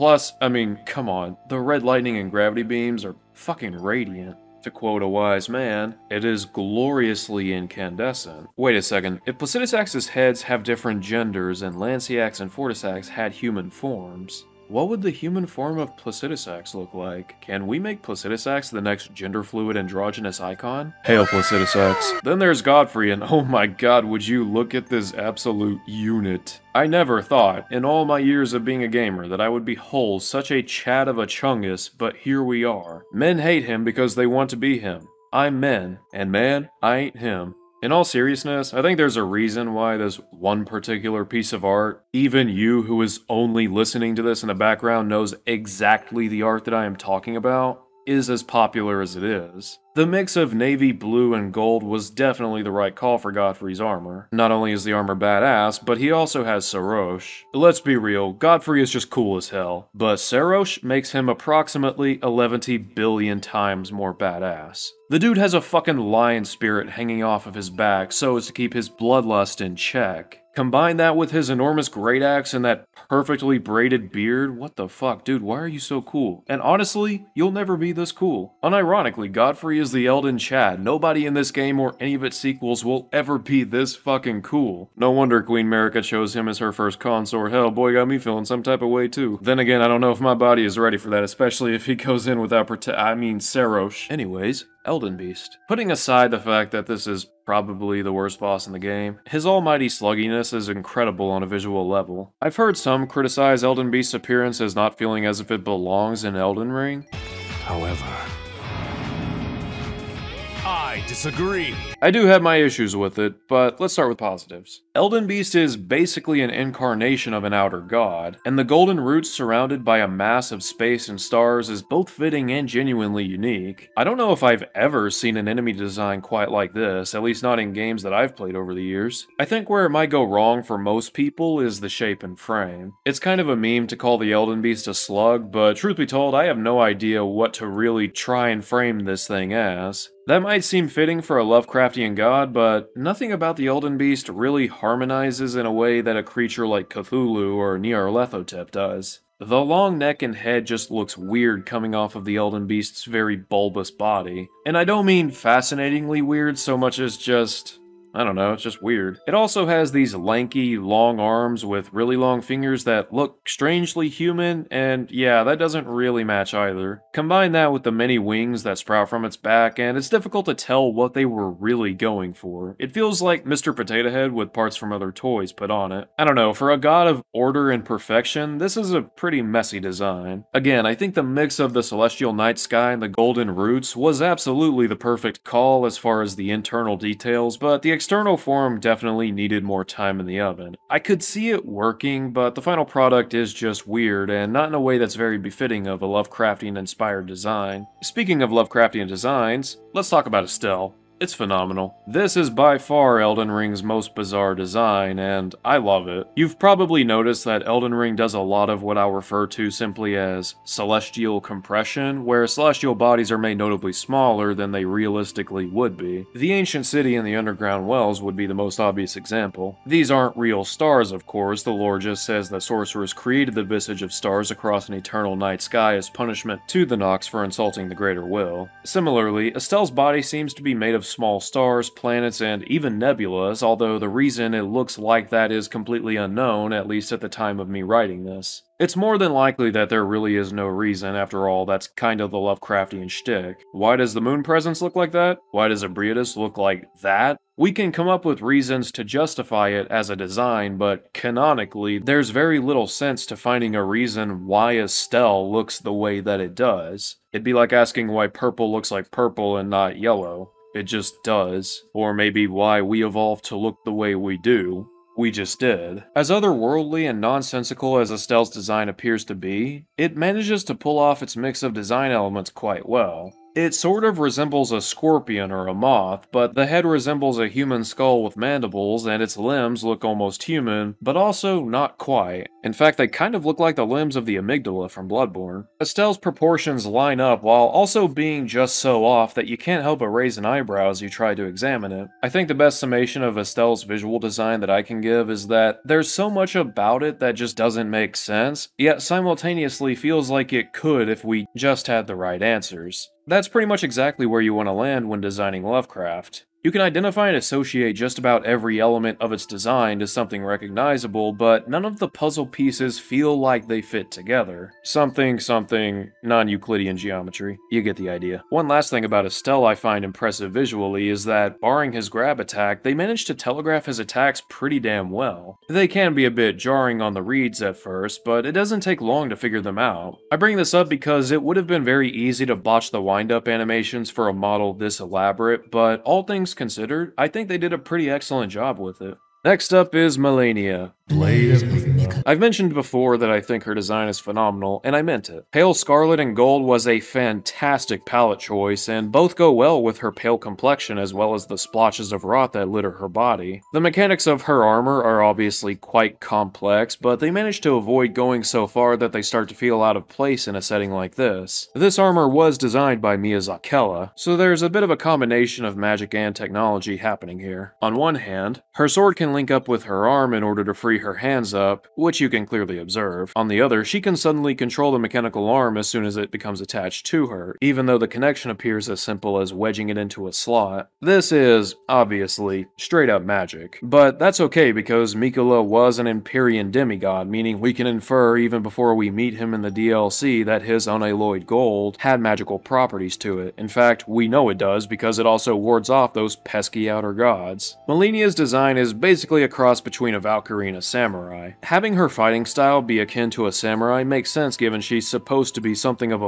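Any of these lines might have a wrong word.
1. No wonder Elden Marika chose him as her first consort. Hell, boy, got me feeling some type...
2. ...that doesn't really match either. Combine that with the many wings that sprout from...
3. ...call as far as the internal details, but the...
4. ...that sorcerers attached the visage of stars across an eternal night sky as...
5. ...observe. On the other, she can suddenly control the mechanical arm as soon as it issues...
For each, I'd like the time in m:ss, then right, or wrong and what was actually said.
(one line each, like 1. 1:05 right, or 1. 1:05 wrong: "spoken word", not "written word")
1. 1:24 wrong: "Queen", not "Elden"
2. 2:45 right
3. 3:05 right
4. 3:42 wrong: "created", not "attached"
5. 6:12 wrong: "becomes", not "issues".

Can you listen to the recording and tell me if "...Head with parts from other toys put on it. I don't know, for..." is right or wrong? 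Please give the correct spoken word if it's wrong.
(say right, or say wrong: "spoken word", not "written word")
right.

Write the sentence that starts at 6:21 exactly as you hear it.
This is, obviously, straight up magic.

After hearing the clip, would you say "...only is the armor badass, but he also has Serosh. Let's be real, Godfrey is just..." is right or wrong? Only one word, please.
right.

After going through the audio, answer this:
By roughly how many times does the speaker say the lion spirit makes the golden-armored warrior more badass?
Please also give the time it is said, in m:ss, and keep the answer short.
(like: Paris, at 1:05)
11 billion, at 1:02.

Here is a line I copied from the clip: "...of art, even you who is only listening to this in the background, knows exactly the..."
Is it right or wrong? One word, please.
right.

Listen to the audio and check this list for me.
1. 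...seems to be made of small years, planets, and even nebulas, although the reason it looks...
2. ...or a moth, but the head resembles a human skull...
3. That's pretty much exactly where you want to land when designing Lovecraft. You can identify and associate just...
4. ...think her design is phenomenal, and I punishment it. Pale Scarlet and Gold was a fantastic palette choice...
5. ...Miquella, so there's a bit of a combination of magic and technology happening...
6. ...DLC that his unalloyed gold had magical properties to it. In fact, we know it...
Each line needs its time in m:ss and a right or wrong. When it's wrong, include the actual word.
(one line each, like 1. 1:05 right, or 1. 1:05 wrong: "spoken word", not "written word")
1. 3:50 wrong: "stars", not "years"
2. 4:35 right
3. 5:03 right
4. 5:43 wrong: "meant", not "punishment"
5. 6:03 right
6. 6:29 right.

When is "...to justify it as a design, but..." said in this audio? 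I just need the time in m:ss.
4:08.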